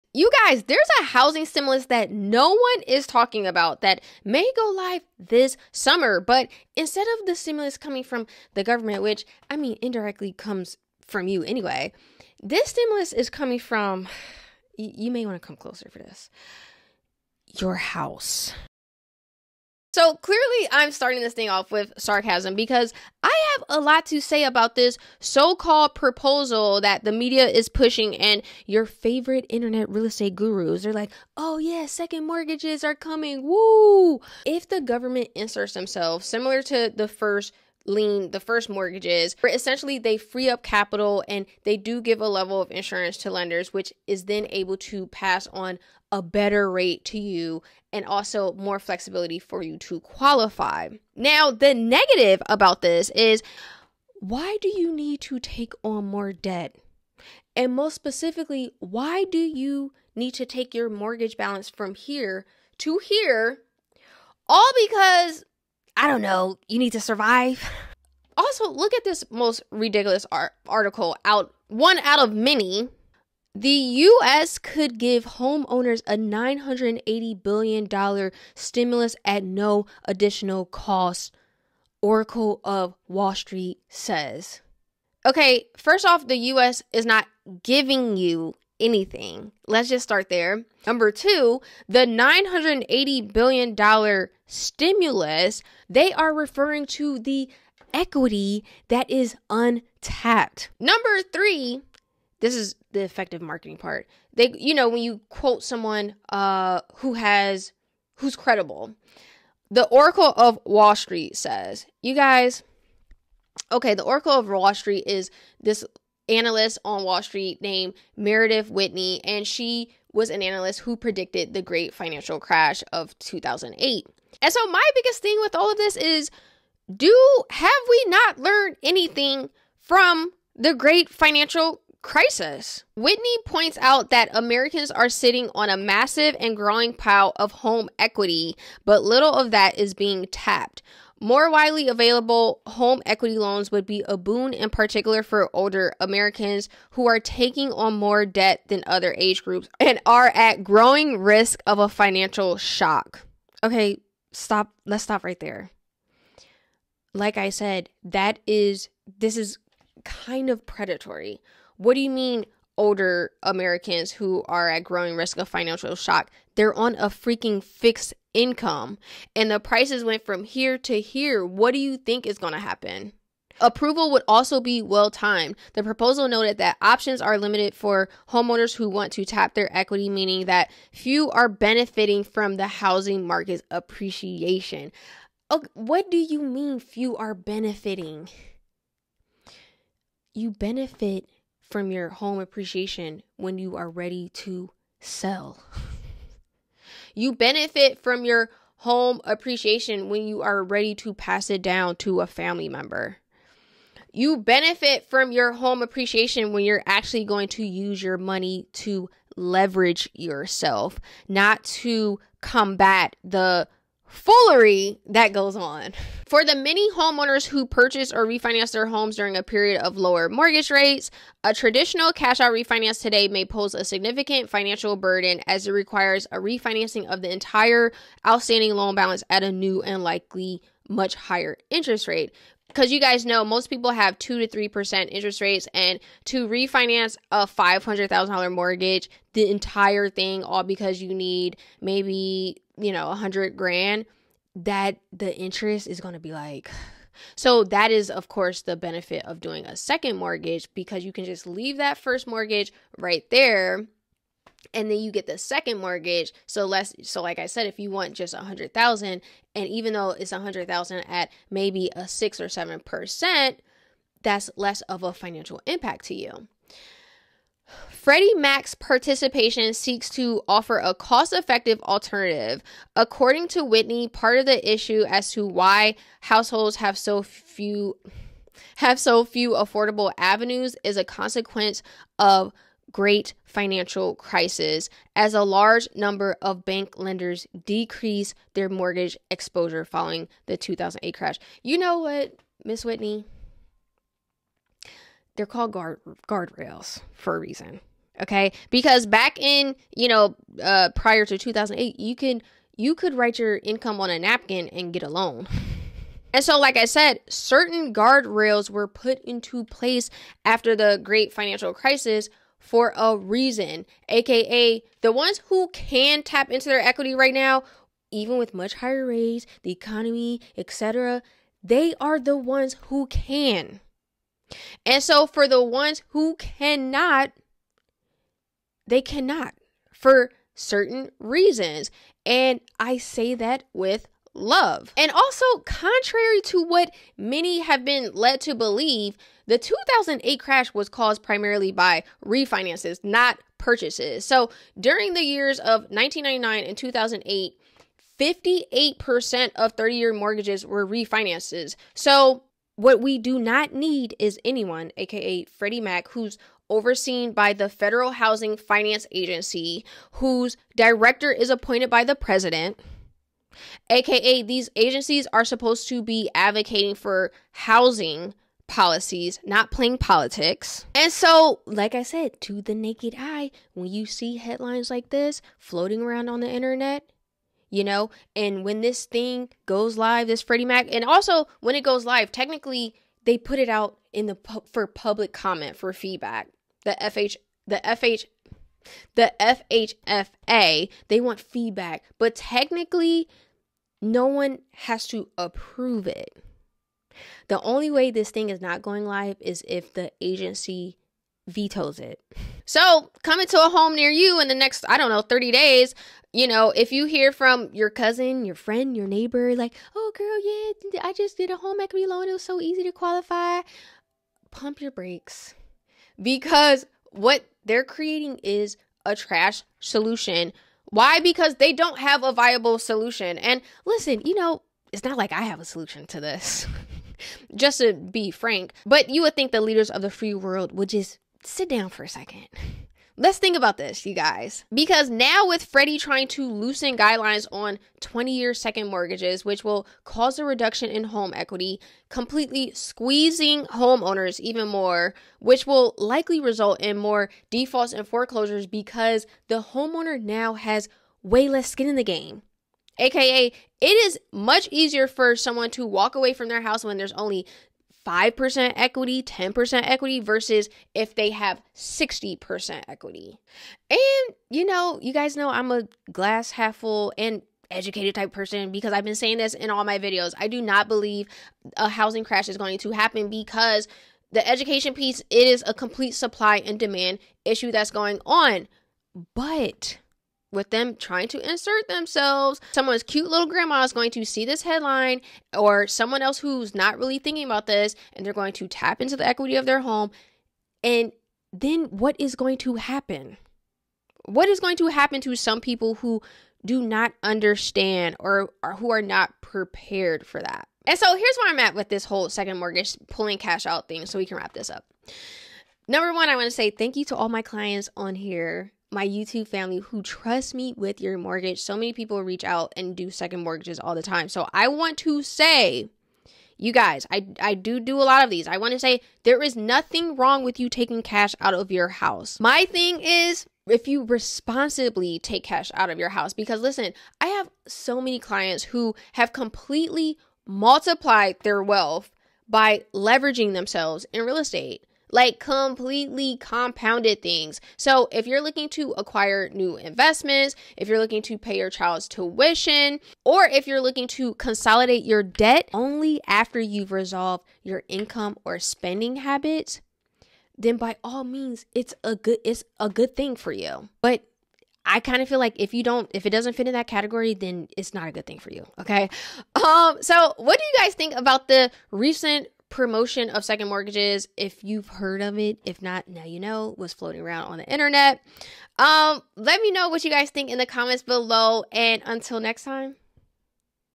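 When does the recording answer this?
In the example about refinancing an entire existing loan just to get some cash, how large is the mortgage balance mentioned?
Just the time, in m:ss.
3:57.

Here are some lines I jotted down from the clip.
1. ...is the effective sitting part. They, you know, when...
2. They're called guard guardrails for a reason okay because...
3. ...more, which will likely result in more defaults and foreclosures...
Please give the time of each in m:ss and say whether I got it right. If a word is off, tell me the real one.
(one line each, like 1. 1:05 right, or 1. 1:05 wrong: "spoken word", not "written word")
1. 1:42 wrong: "marketing", not "sitting"
2. 4:55 right
3. 7:24 right.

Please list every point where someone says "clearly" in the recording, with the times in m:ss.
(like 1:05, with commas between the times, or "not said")
0:20.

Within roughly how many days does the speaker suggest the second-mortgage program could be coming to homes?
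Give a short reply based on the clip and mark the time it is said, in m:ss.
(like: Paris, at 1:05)
30 days, at 6:45.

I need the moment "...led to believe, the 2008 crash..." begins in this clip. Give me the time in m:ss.
5:38.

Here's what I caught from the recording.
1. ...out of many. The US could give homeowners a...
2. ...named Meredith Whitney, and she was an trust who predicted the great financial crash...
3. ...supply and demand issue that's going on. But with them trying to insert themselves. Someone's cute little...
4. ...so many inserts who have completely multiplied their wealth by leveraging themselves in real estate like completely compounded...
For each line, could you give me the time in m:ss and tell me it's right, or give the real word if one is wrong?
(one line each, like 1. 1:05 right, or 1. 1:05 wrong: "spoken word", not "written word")
1. 1:11 right
2. 1:57 wrong: "analyst", not "trust"
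3. 7:56 right
4. 8:47 wrong: "clients", not "inserts".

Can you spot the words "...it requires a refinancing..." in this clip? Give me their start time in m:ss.
3:45.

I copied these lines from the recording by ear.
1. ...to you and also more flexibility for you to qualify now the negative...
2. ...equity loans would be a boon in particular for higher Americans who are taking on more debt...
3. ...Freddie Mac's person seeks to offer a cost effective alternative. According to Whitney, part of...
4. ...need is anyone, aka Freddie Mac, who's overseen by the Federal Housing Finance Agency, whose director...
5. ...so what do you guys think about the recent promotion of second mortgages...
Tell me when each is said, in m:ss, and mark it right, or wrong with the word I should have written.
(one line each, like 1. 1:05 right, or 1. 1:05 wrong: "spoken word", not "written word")
1. 0:47 right
2. 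2:23 wrong: "older", not "higher"
3. 4:28 wrong: "participation", not "person"
4. 5:53 right
5. 9:20 right.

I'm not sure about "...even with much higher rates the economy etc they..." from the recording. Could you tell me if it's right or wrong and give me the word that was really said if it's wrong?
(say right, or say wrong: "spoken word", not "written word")
right.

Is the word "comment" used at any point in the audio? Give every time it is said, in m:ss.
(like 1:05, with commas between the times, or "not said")
6:25, 9:30.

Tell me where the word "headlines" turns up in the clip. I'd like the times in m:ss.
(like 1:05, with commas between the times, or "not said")
6:14, 8:04.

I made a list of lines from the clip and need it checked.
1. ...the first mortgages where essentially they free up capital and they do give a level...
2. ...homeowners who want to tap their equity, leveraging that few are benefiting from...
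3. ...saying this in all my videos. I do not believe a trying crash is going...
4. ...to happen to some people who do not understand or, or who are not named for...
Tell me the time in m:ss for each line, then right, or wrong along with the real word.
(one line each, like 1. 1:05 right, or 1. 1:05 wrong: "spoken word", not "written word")
1. 0:38 right
2. 2:58 wrong: "meaning", not "leveraging"
3. 7:49 wrong: "housing", not "trying"
4. 8:14 wrong: "prepared", not "named".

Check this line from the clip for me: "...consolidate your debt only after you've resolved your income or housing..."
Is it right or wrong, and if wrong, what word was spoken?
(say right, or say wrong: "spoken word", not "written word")
wrong: "spending", not "housing".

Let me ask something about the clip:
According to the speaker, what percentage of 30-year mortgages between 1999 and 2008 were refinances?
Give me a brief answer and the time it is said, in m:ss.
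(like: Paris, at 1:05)
58%, at 5:48.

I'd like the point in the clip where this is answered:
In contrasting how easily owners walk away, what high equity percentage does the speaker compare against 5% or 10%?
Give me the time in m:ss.
7:41.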